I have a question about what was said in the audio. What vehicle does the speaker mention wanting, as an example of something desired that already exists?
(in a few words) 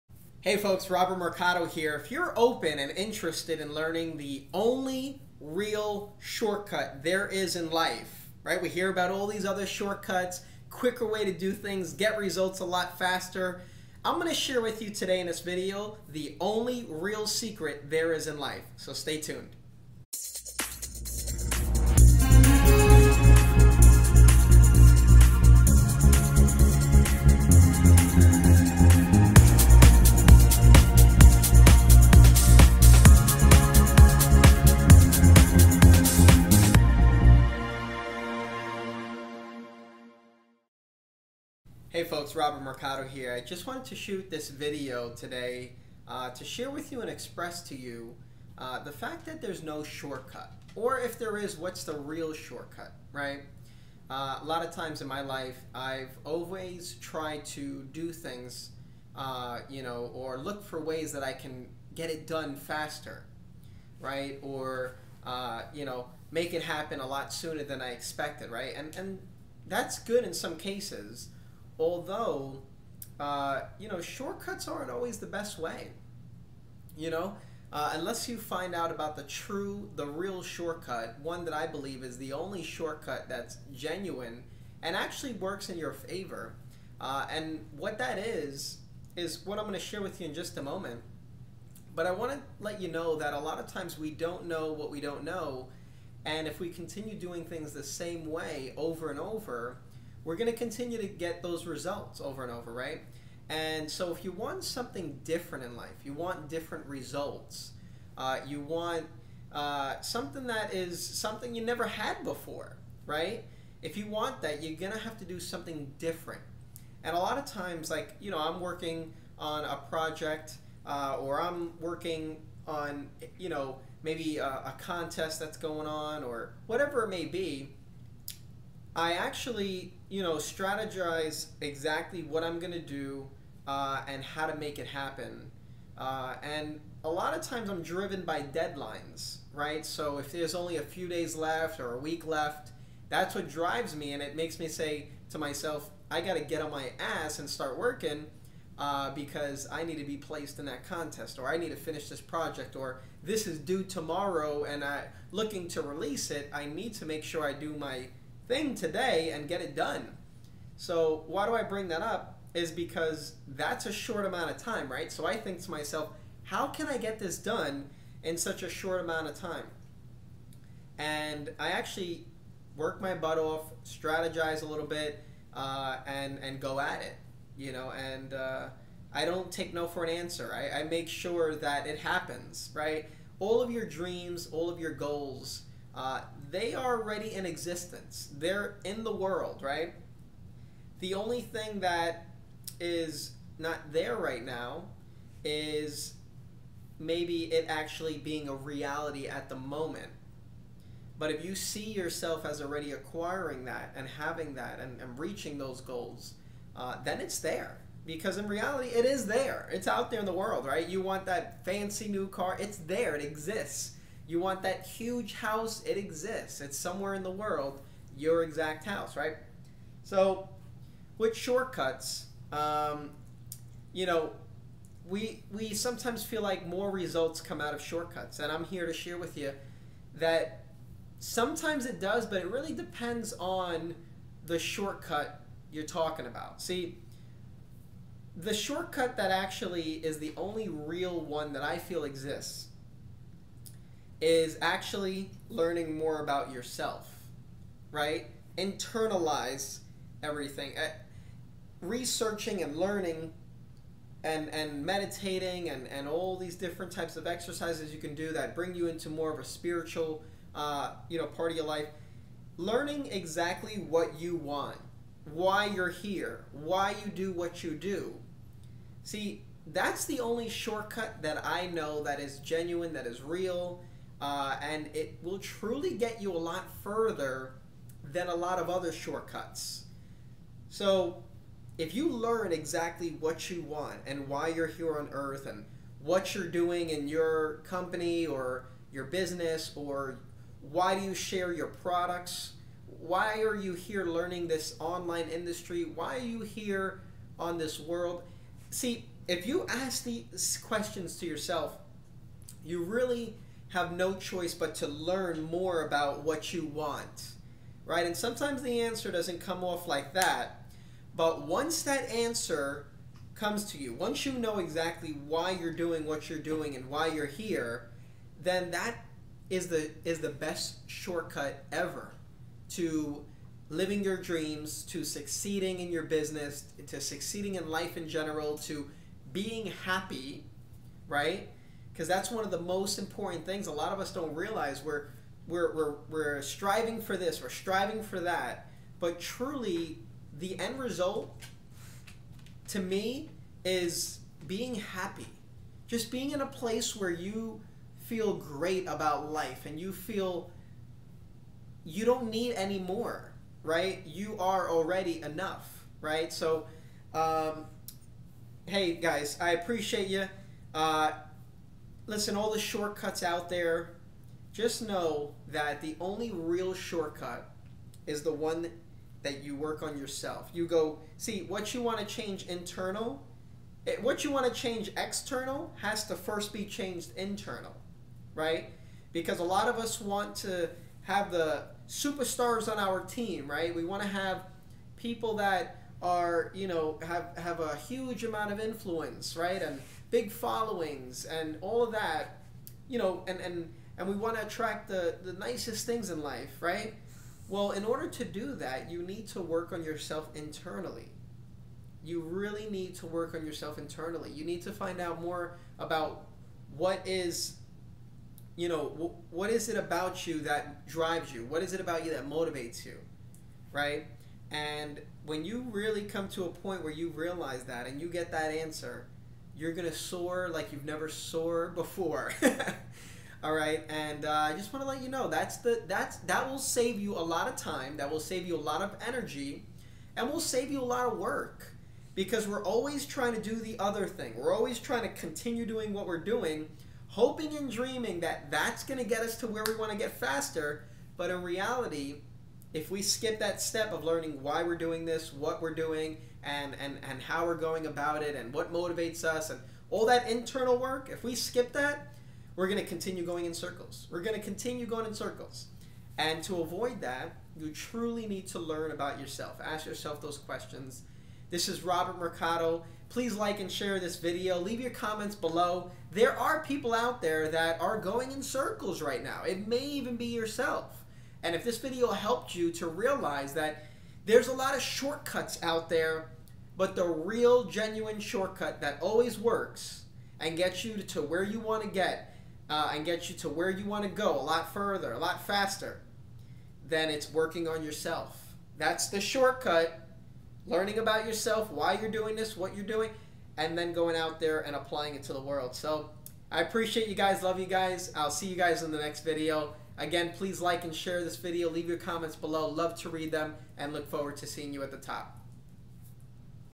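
Fancy new car.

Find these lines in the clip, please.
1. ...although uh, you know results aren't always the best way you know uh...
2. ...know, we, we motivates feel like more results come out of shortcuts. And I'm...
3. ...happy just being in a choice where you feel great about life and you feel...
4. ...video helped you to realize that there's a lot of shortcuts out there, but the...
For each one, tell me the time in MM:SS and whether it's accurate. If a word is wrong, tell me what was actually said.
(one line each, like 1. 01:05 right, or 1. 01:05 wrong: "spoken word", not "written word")
1. 01:11 wrong: "shortcuts", not "results"
2. 03:44 wrong: "sometimes", not "motivates"
3. 05:44 wrong: "place", not "choice"
4. 07:51 right.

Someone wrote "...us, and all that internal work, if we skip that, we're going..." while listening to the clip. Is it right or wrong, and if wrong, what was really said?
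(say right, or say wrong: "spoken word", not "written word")
right.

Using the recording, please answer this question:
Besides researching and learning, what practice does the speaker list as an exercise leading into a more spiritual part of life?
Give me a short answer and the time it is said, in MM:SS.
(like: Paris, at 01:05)
Meditating, at 04:14.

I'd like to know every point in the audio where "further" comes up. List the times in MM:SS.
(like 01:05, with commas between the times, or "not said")
04:36, 08:04.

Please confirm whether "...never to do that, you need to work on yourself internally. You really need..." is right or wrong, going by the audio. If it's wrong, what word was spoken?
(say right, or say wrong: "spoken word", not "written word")
wrong: "order", not "never".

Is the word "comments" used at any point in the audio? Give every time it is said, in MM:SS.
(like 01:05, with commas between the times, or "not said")
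07:44, 08:21.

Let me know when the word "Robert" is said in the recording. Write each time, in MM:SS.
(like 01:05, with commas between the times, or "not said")
00:00, 00:42, 07:41.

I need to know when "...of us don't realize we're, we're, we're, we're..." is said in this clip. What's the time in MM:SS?
05:33.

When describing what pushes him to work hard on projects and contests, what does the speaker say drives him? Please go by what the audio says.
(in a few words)
Deadlines.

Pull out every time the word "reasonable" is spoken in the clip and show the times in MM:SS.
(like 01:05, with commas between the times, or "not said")
not said.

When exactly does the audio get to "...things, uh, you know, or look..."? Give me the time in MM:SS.
00:58.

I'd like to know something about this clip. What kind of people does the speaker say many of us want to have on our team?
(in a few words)
Superstars.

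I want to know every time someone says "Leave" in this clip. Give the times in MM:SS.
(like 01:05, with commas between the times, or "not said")
07:44, 08:21.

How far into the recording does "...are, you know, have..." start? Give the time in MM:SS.
06:26.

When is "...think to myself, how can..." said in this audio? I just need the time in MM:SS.
02:45.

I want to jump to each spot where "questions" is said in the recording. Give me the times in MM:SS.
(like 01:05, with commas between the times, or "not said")
05:00, 07:40.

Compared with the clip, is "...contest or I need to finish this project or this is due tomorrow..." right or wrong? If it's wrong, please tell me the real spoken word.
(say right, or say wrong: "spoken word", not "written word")
right.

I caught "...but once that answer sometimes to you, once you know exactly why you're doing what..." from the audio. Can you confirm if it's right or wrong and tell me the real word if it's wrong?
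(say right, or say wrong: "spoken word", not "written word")
wrong: "comes", not "sometimes".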